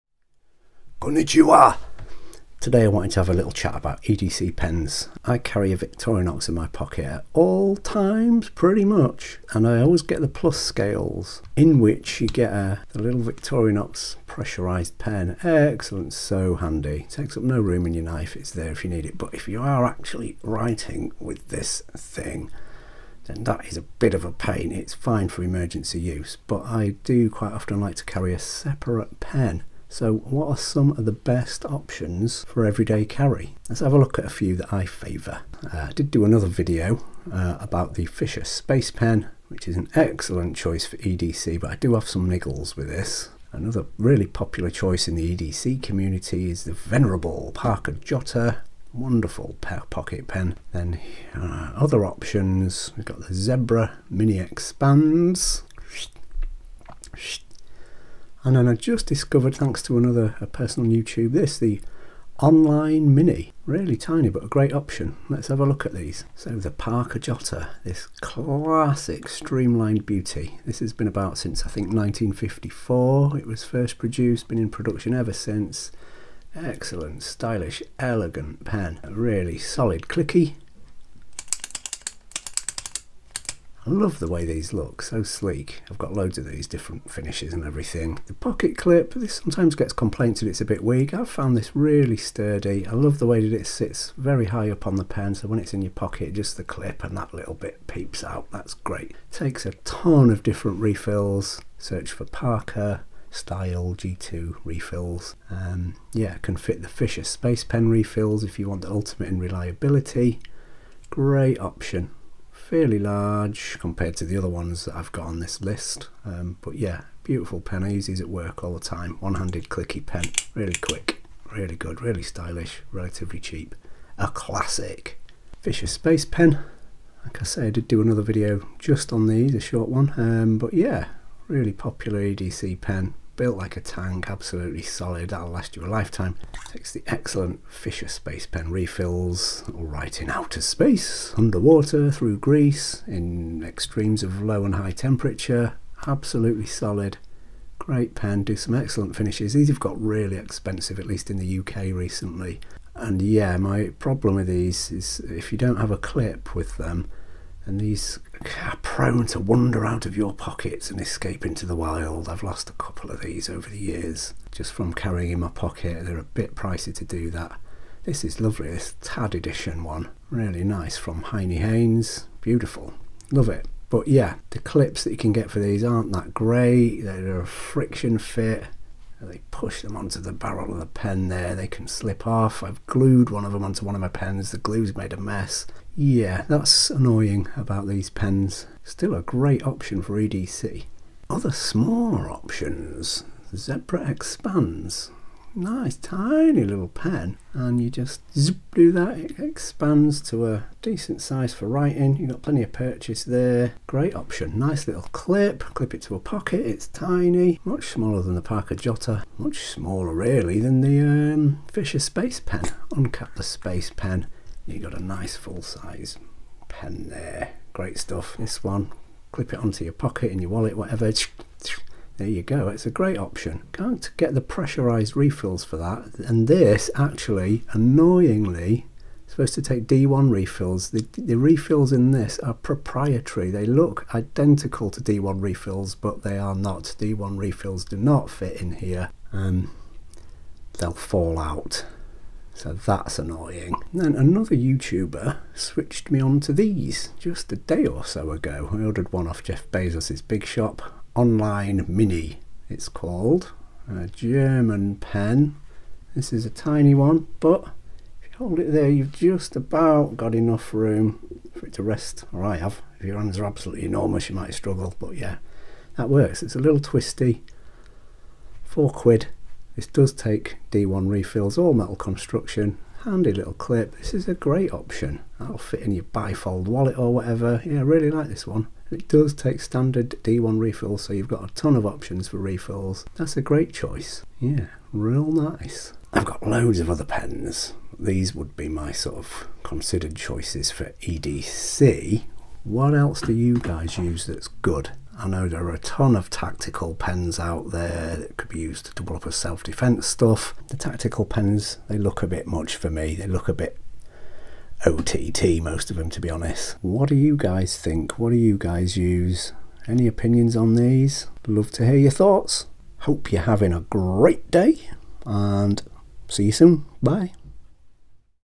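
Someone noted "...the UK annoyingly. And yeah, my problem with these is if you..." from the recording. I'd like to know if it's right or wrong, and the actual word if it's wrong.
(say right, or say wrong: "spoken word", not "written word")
wrong: "recently", not "annoyingly".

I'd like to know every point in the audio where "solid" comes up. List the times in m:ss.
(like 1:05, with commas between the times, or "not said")
1:19, 2:14, 2:26.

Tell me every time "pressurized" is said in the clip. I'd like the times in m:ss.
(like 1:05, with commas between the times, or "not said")
0:14, 3:44.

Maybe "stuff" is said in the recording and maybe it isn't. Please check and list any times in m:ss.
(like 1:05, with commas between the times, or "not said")
3:37, 5:00.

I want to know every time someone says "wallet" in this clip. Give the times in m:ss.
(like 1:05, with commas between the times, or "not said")
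3:40, 4:36.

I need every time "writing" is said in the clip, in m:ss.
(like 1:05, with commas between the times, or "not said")
0:20, 3:21.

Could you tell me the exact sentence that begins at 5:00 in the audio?
The tactical pens, they look a bit much for me.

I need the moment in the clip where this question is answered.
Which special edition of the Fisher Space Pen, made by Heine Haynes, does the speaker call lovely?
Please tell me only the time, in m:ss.
2:49.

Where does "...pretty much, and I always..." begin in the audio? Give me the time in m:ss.
0:08.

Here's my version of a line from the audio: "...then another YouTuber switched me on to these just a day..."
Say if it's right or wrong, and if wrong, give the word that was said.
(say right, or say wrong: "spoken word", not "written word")
right.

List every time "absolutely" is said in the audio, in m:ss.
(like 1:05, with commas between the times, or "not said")
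2:14, 2:26, 4:23.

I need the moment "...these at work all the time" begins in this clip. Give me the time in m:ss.
1:58.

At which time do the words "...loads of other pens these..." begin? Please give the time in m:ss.
4:46.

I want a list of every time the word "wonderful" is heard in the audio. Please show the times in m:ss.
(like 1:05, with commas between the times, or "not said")
0:48.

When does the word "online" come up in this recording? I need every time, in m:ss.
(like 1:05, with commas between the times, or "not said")
1:02, 4:11.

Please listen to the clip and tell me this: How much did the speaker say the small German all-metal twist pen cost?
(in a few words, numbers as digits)
£4.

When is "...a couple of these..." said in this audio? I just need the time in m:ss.
2:42.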